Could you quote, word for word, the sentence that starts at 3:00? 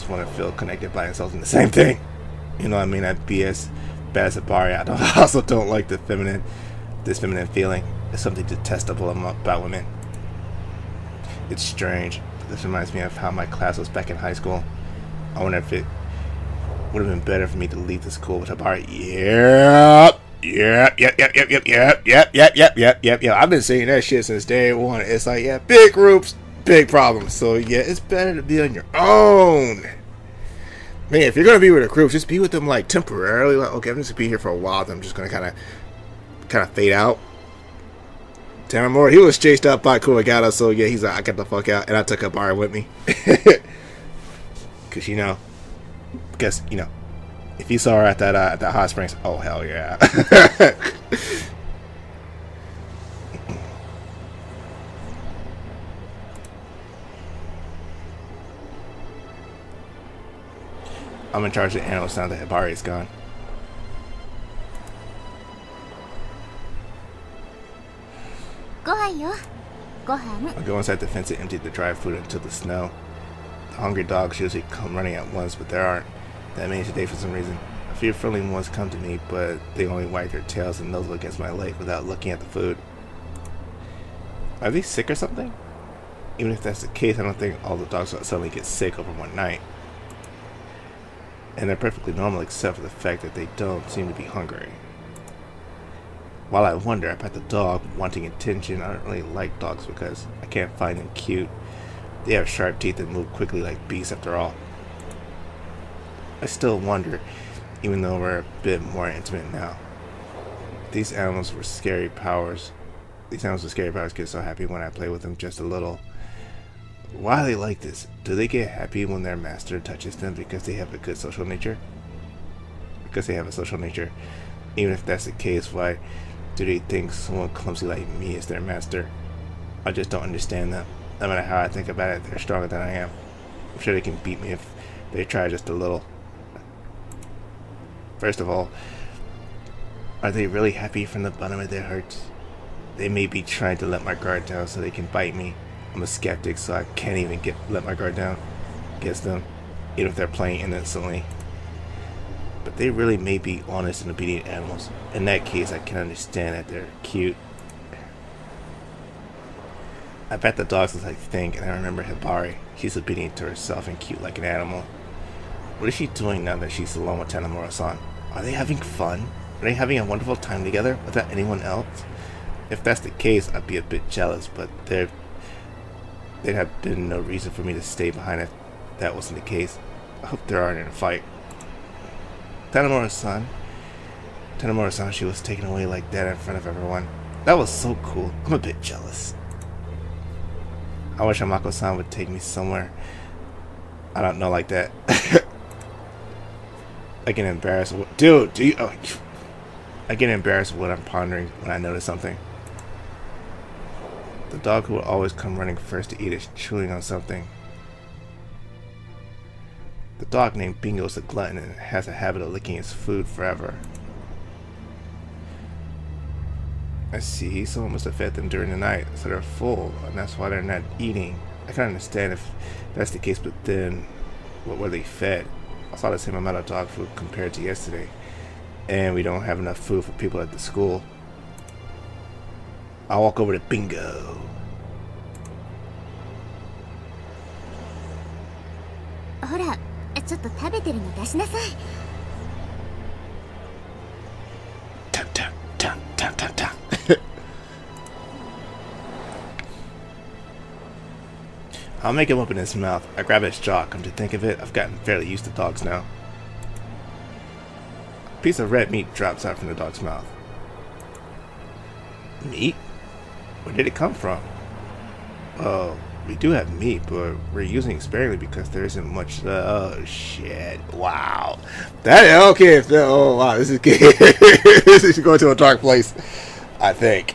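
I hope there aren't in a fight.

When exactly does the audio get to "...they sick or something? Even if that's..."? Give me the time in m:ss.
1:24.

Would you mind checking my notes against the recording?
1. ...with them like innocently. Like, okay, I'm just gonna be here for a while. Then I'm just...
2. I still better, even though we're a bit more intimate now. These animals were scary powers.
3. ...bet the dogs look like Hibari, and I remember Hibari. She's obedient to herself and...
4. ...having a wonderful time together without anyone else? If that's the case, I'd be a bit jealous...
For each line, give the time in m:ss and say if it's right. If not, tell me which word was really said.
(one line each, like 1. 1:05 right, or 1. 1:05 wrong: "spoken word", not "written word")
1. 0:32 wrong: "temporarily", not "innocently"
2. 1:46 wrong: "wonder", not "better"
3. 2:40 wrong: "Think", not "Hibari"
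4. 2:49 right.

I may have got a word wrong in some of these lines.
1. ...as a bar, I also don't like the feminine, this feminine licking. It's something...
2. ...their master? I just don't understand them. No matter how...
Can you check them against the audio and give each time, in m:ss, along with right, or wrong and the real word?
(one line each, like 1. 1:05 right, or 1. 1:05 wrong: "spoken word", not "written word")
1. 0:04 wrong: "feeling", not "licking"
2. 2:08 right.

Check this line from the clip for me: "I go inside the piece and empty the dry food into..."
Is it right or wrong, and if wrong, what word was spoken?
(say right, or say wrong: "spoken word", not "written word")
wrong: "fence", not "piece".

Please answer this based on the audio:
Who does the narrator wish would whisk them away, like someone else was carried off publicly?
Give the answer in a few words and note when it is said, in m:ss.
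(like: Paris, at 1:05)
Amako-san, at 3:11.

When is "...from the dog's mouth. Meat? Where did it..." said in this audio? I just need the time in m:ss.
4:19.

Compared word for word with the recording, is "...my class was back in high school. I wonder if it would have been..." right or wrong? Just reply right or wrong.
right.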